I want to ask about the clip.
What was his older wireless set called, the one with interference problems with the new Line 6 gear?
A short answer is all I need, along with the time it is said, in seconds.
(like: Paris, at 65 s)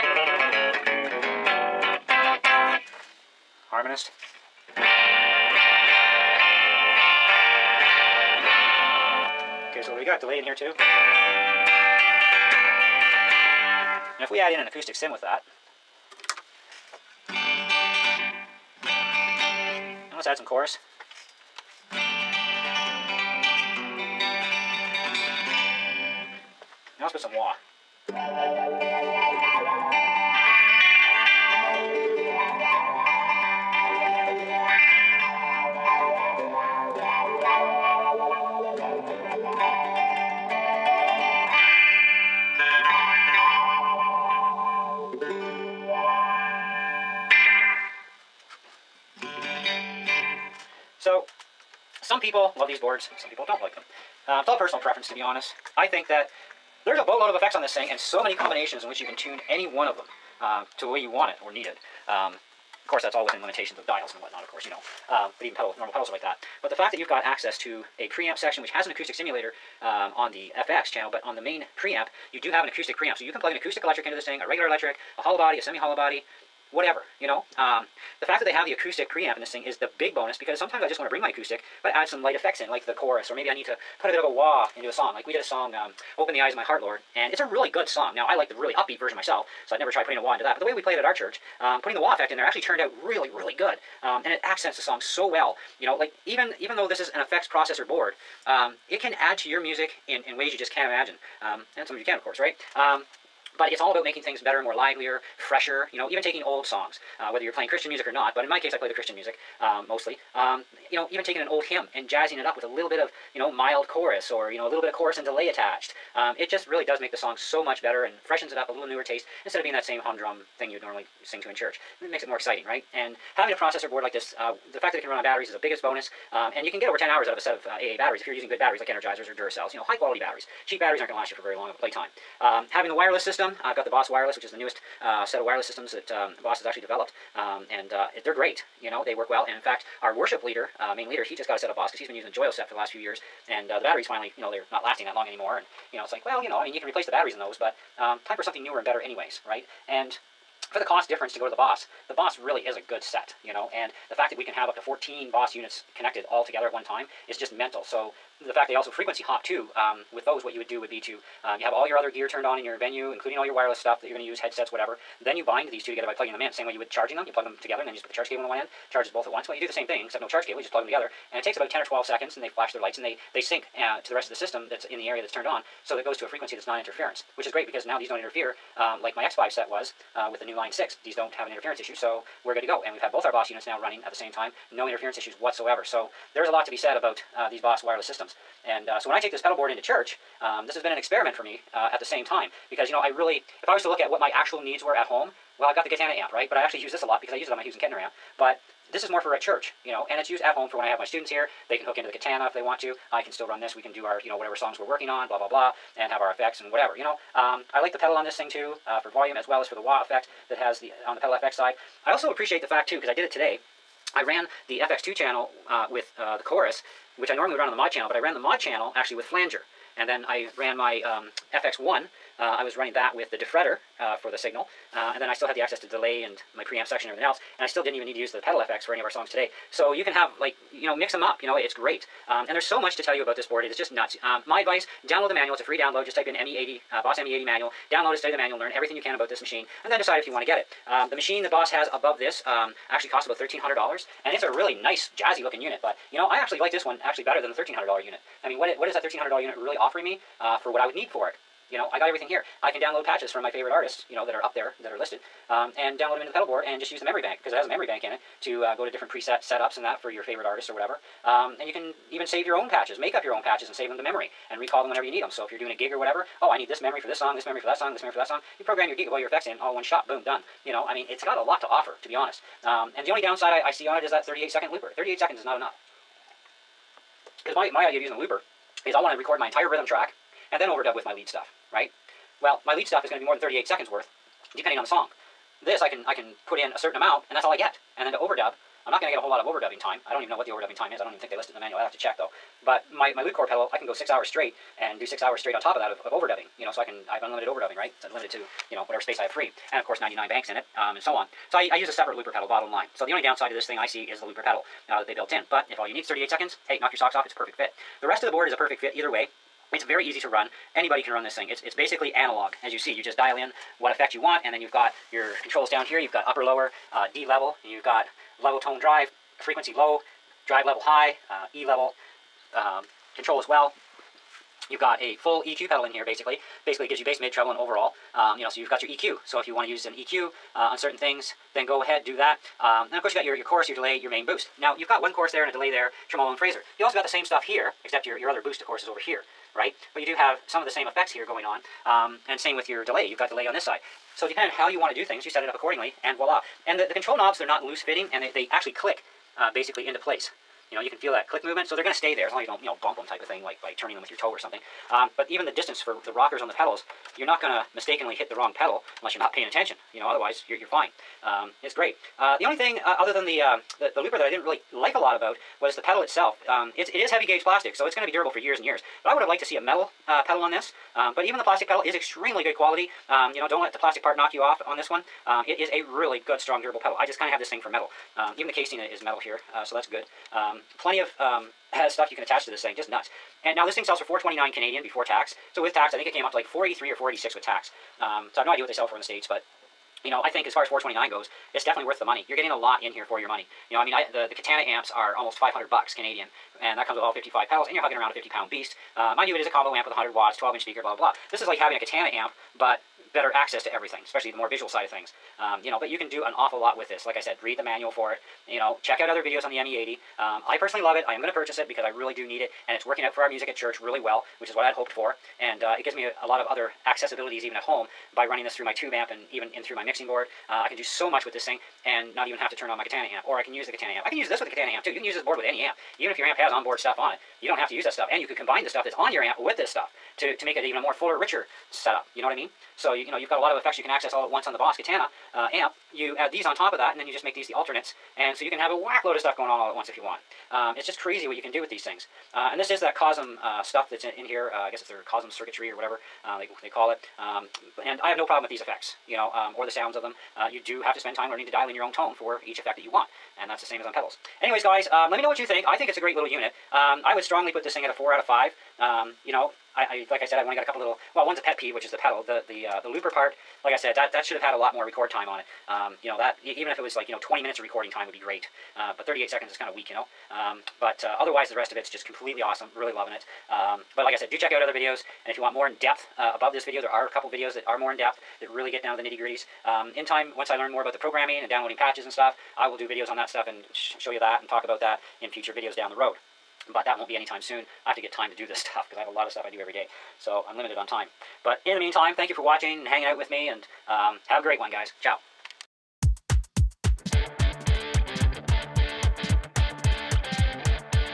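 X5, at 179 s.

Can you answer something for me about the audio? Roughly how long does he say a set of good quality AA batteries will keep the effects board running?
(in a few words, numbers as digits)
over 10 hours.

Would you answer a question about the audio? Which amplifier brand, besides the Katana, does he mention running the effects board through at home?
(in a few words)
Hughes and Kettner.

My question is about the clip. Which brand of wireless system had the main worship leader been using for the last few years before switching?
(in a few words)
Joyo.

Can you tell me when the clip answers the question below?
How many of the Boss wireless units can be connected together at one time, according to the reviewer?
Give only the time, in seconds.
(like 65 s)
154 s.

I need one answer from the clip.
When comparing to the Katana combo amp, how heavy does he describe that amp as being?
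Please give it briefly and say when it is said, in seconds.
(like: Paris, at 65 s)
50 pounds, at 398 s.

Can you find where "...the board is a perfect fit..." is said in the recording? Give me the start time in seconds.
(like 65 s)
308 s.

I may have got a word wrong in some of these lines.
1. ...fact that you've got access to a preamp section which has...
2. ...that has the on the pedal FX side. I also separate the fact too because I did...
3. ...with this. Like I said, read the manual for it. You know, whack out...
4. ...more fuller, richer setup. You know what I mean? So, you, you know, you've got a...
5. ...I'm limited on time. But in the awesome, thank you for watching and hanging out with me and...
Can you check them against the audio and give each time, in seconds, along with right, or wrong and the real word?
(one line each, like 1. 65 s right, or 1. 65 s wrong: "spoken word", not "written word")
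1. 66 s right
2. 210 s wrong: "appreciate", not "separate"
3. 406 s wrong: "check", not "whack"
4. 430 s right
5. 490 s wrong: "meantime", not "awesome".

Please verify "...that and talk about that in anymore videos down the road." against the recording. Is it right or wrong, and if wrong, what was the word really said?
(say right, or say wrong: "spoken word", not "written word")
wrong: "future", not "anymore".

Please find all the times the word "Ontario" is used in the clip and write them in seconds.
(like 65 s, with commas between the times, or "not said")
not said.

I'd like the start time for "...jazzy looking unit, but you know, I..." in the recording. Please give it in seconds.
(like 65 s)
245 s.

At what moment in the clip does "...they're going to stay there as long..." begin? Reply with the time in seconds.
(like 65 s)
351 s.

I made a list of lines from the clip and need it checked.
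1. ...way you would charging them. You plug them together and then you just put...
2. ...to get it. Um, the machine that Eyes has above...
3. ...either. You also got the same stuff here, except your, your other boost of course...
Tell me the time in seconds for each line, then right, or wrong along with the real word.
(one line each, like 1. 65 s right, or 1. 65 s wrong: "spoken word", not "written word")
1. 166 s right
2. 240 s wrong: "Boss", not "Eyes"
3. 336 s wrong: "phaser", not "either".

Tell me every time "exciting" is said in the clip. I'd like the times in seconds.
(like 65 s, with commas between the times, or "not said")
122 s.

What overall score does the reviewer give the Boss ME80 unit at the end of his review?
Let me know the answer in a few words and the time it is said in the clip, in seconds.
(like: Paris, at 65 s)
4 out of 5, at 457 s.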